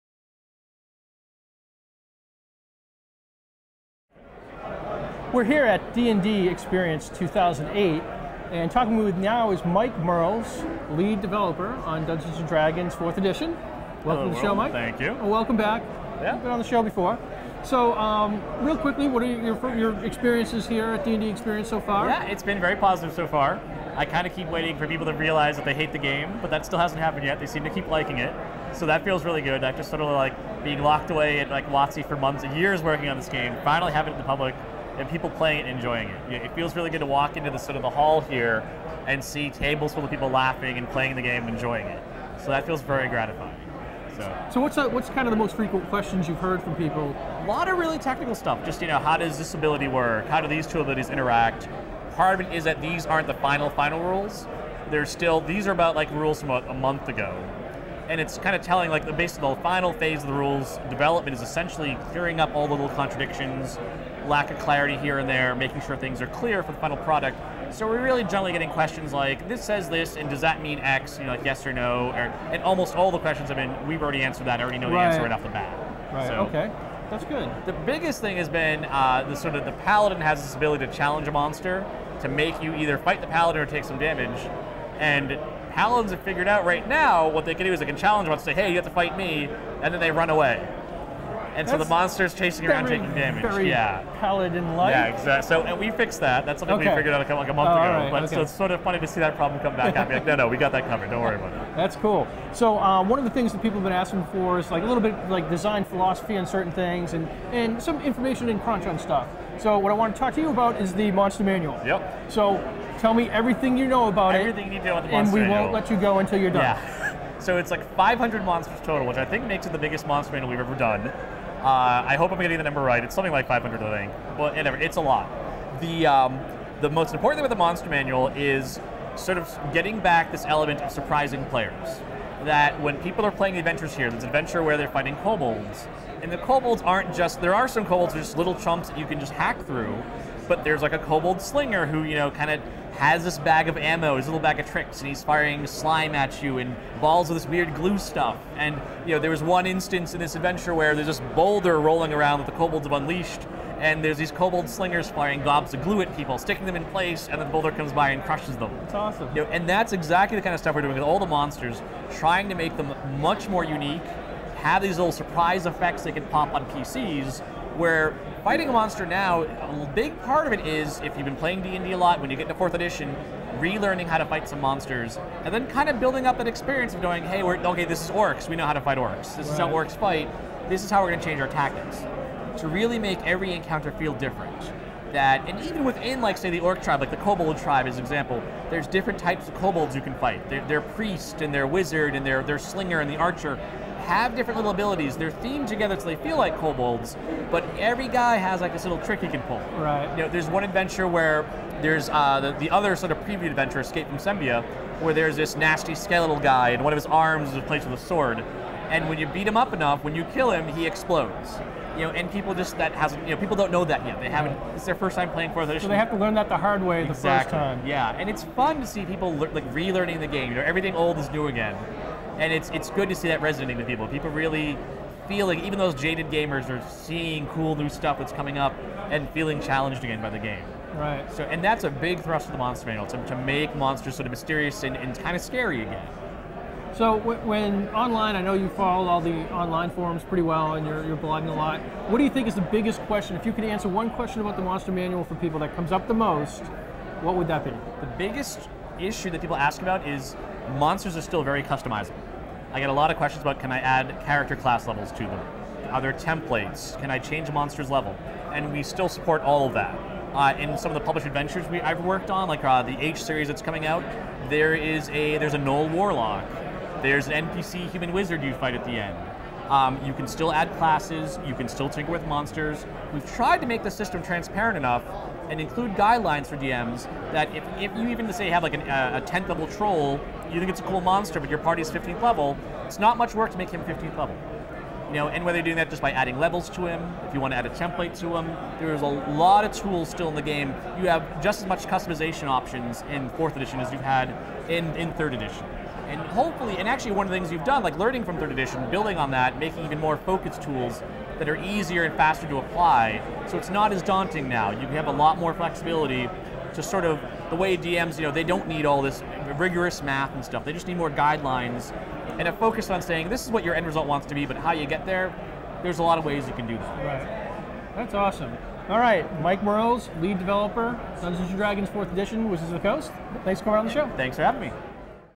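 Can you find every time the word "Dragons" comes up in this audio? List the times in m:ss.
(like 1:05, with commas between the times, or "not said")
0:12, 5:21.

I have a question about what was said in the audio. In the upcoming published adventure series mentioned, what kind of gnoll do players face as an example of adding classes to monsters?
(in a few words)
Gnoll Warlock.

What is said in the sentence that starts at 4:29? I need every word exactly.
Um, you can still add classes, you can still tinker with monsters.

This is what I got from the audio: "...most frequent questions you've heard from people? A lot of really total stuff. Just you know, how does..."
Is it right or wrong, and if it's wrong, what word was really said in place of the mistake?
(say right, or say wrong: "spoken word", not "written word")
wrong: "technical", not "total".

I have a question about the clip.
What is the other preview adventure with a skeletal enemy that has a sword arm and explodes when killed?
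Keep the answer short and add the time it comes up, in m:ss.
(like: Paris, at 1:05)
Escape from Sembia, at 3:23.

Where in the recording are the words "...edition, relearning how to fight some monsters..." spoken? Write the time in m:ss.
2:52.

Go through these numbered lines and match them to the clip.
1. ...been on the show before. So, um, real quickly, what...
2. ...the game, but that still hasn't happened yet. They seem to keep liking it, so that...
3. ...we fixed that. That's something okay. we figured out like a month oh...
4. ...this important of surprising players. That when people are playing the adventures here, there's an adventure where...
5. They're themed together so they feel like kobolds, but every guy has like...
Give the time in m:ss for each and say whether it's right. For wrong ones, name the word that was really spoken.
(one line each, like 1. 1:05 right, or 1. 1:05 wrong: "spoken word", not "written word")
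1. 0:16 right
2. 0:25 right
3. 1:35 right
4. 2:10 wrong: "element", not "important"
5. 3:15 right.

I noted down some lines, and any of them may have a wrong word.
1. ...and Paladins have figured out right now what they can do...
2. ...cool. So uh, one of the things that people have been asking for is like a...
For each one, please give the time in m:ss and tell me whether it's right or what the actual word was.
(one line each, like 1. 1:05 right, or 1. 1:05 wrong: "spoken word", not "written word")
1. 1:24 right
2. 1:41 right.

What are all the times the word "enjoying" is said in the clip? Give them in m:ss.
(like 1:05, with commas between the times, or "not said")
0:35, 0:41.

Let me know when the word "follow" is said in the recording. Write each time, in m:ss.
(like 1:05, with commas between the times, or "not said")
3:58.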